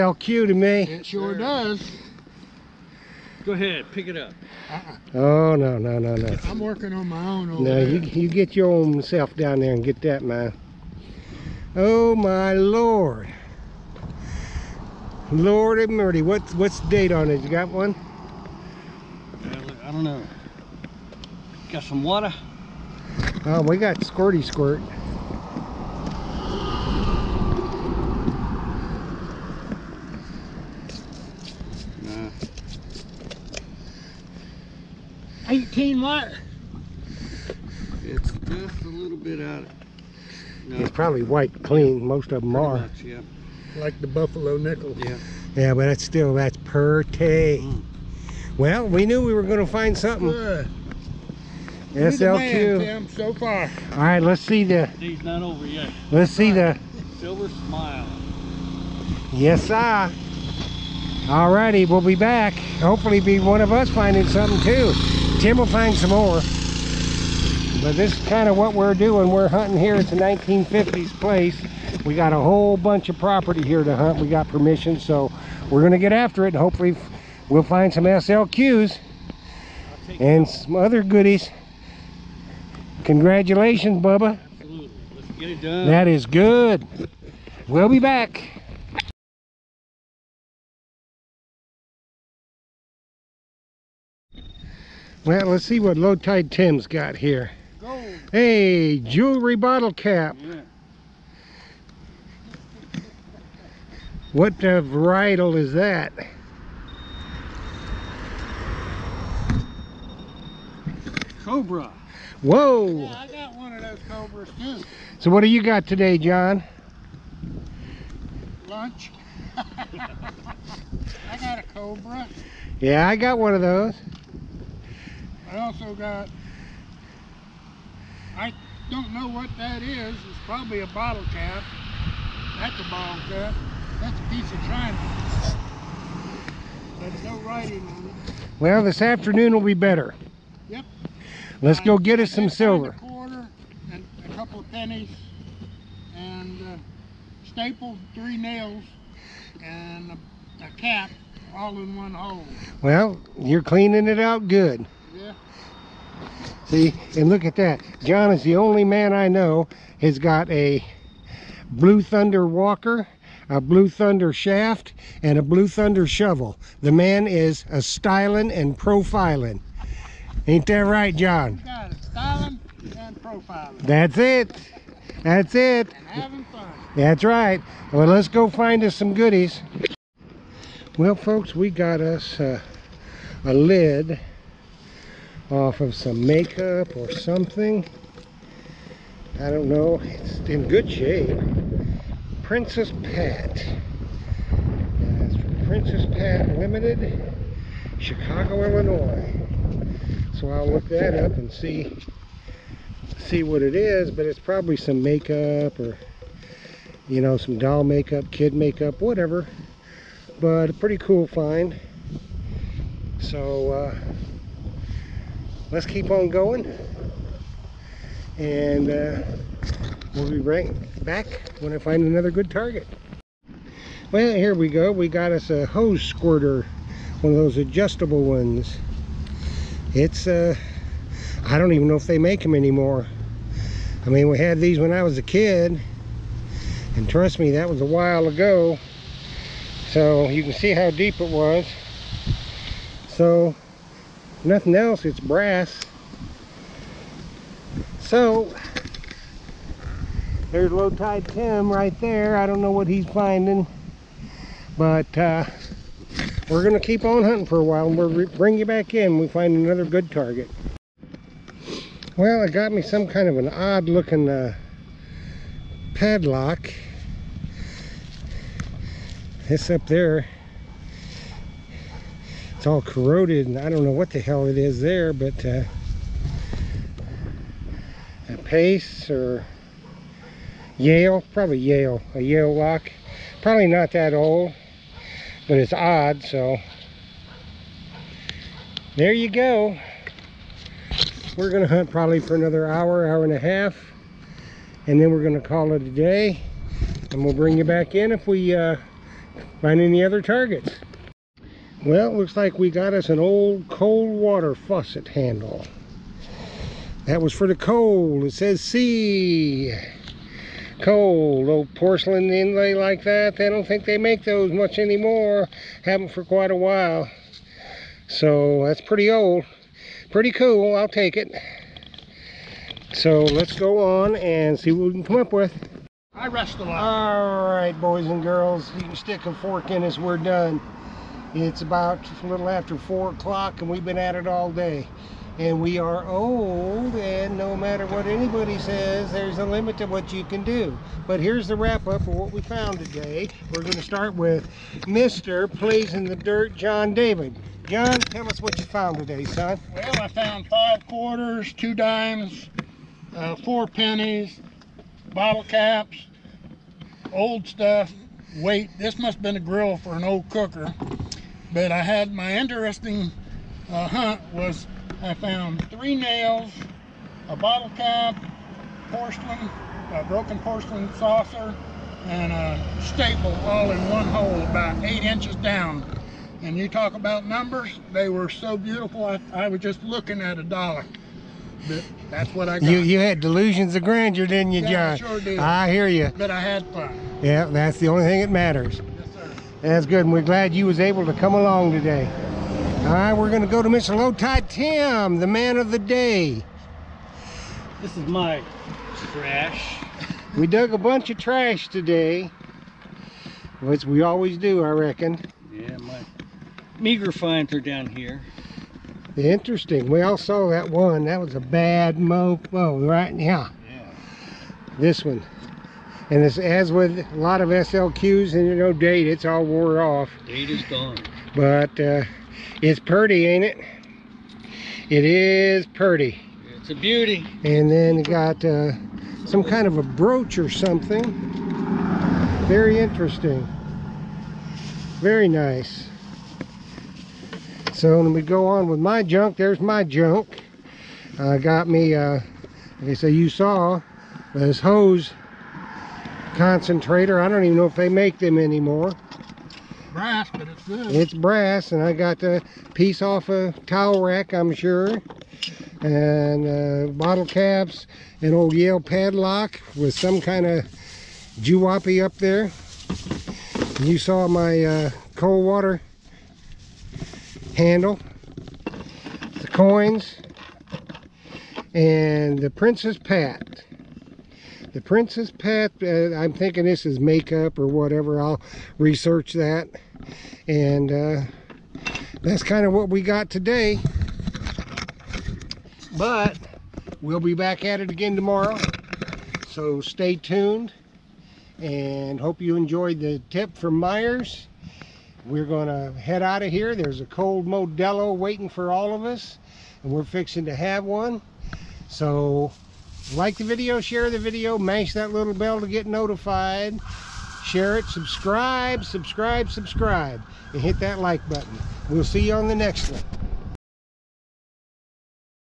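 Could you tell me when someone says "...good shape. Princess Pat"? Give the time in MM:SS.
03:10.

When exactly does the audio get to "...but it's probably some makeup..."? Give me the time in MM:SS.
03:24.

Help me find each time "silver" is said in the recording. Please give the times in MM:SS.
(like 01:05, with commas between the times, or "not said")
00:57, 02:22.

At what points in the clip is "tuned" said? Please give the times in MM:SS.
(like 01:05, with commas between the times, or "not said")
08:10.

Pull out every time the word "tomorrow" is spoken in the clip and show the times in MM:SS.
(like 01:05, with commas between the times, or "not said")
08:08.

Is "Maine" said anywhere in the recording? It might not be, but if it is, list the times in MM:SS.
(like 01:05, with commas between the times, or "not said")
not said.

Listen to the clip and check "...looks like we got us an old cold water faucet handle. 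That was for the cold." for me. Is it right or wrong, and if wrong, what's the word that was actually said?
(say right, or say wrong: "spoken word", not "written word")
right.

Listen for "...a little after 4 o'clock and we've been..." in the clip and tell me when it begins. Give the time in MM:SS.
05:32.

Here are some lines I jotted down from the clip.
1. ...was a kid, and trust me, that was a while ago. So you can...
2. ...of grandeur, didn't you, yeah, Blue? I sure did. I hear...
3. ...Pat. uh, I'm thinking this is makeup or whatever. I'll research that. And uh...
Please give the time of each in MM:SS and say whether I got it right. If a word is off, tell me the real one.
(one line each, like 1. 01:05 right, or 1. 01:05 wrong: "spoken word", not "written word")
1. 03:55 right
2. 06:23 wrong: "John", not "Blue"
3. 07:55 right.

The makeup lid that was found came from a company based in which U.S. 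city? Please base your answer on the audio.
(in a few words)
Chicago.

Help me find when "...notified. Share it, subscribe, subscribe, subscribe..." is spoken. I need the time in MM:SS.
08:25.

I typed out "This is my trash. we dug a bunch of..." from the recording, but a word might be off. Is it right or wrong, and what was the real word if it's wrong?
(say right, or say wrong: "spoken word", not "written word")
right.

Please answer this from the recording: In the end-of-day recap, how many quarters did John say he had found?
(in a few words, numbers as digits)
5.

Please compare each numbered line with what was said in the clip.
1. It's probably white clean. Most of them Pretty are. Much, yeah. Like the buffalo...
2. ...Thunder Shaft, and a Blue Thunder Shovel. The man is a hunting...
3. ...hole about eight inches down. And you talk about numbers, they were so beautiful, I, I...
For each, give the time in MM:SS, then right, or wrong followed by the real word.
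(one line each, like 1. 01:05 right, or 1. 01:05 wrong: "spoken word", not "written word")
1. 00:40 right
2. 02:43 wrong: "styling", not "hunting"
3. 06:14 right.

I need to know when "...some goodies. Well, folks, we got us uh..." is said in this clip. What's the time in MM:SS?
02:58.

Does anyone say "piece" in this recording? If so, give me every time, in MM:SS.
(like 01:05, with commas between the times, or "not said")
02:14, 07:32.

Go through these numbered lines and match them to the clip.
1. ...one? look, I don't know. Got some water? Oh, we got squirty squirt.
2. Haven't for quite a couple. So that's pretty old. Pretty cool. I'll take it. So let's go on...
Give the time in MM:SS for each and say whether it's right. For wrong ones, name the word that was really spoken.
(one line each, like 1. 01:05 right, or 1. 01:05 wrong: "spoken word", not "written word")
1. 00:17 right
2. 05:15 wrong: "while", not "couple".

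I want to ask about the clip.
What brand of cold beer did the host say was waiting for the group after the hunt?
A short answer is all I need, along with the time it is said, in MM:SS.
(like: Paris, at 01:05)
Modelo, at 08:17.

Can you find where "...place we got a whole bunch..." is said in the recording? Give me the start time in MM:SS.
01:11.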